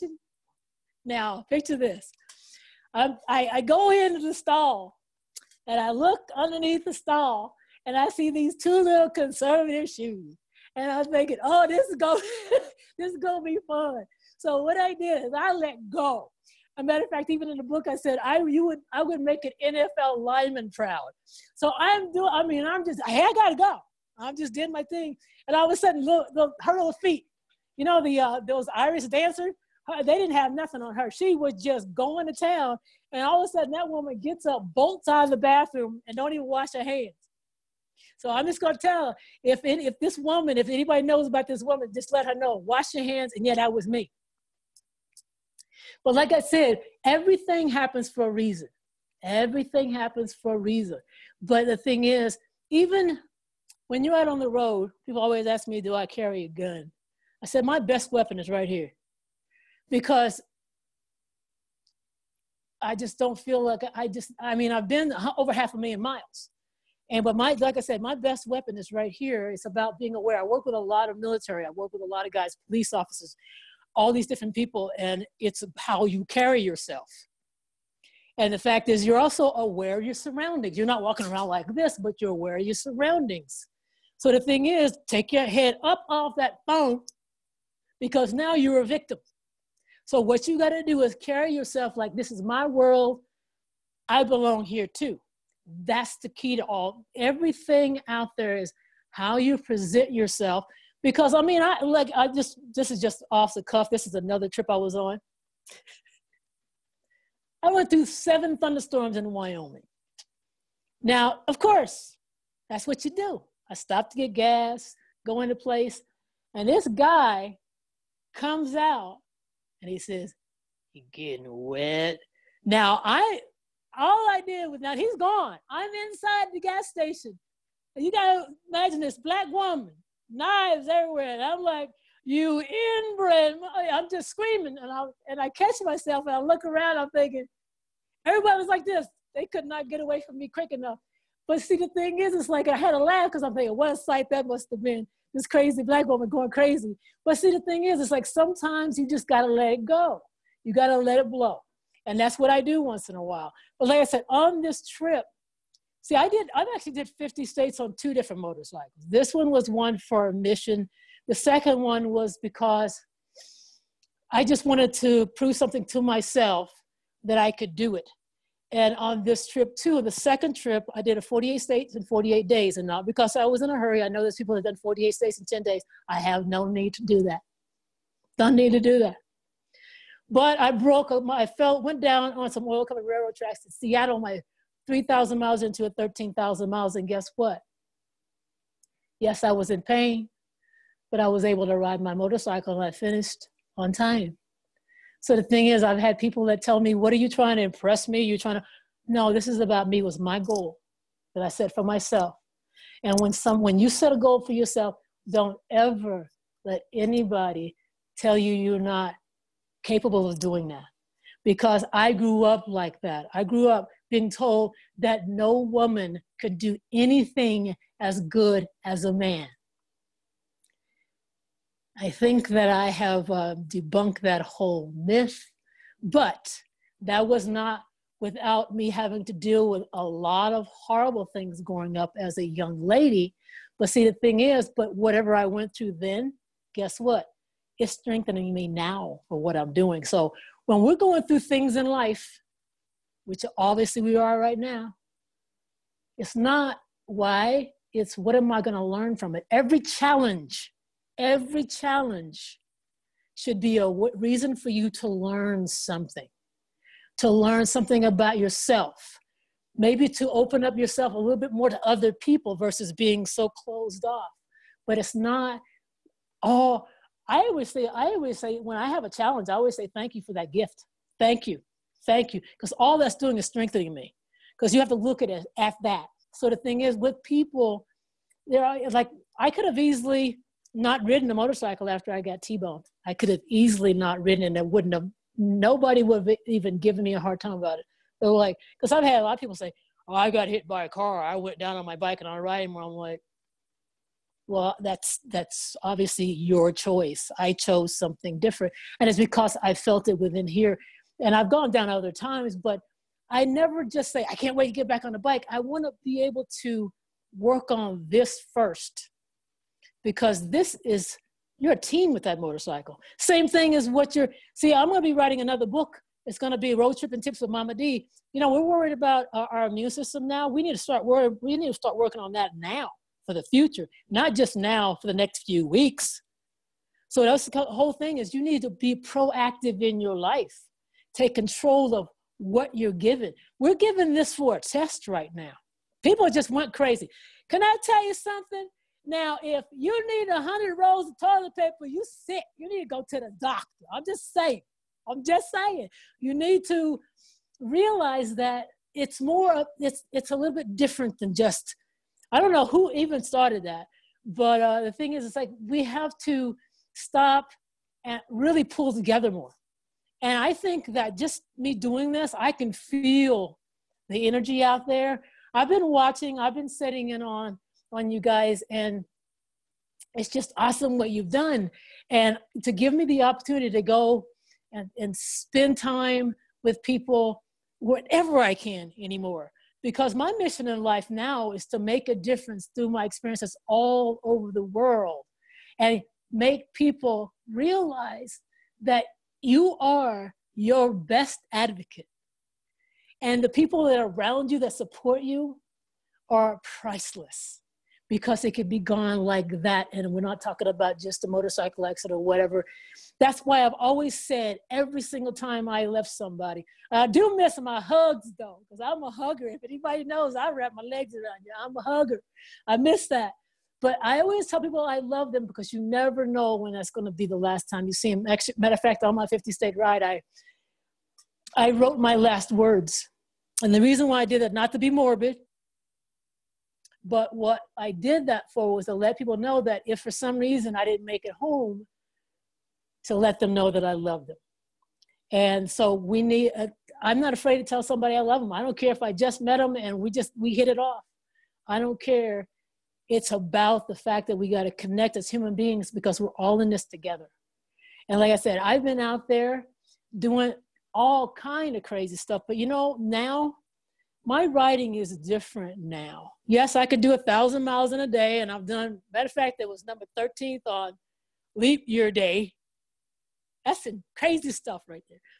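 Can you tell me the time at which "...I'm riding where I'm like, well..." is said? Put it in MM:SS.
04:52.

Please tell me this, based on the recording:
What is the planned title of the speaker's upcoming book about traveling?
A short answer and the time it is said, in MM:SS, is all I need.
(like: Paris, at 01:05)
Road Trip and Tips with Momma D, at 05:16.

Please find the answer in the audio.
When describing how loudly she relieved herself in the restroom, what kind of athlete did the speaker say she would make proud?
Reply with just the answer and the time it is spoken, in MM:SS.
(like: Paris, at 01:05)
NFL lineman, at 00:19.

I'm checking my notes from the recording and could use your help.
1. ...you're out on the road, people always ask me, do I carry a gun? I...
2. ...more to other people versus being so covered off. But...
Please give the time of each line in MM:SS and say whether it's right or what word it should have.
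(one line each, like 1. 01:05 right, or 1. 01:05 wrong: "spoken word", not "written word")
1. 00:54 right
2. 04:21 wrong: "closed", not "covered".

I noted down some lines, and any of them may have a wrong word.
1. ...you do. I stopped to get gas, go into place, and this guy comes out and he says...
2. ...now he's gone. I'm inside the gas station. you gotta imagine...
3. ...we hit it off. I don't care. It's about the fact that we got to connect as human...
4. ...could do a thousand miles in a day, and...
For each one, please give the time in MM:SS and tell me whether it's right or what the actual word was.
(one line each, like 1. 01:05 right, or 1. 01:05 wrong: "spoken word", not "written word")
1. 01:53 right
2. 02:04 right
3. 07:20 right
4. 07:36 right.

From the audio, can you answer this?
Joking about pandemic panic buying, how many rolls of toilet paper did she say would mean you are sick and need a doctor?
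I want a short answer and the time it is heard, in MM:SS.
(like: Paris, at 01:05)
100, at 05:40.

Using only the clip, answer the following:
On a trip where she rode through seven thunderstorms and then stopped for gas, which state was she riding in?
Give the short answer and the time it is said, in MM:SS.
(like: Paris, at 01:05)
Wyoming, at 01:49.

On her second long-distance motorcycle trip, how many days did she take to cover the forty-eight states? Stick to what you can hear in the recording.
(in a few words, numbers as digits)
48.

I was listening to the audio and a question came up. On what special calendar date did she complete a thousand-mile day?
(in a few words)
Leap year day.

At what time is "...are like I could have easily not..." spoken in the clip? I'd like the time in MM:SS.
04:38.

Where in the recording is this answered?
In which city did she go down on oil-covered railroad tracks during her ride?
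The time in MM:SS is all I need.
03:03.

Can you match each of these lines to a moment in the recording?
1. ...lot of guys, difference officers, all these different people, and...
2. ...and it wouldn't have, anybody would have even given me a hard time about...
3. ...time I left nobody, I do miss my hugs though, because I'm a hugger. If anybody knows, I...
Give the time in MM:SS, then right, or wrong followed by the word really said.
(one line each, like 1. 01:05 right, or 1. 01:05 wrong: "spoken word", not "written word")
1. 01:12 wrong: "police", not "difference"
2. 04:44 wrong: "nobody", not "anybody"
3. 06:45 wrong: "somebody", not "nobody".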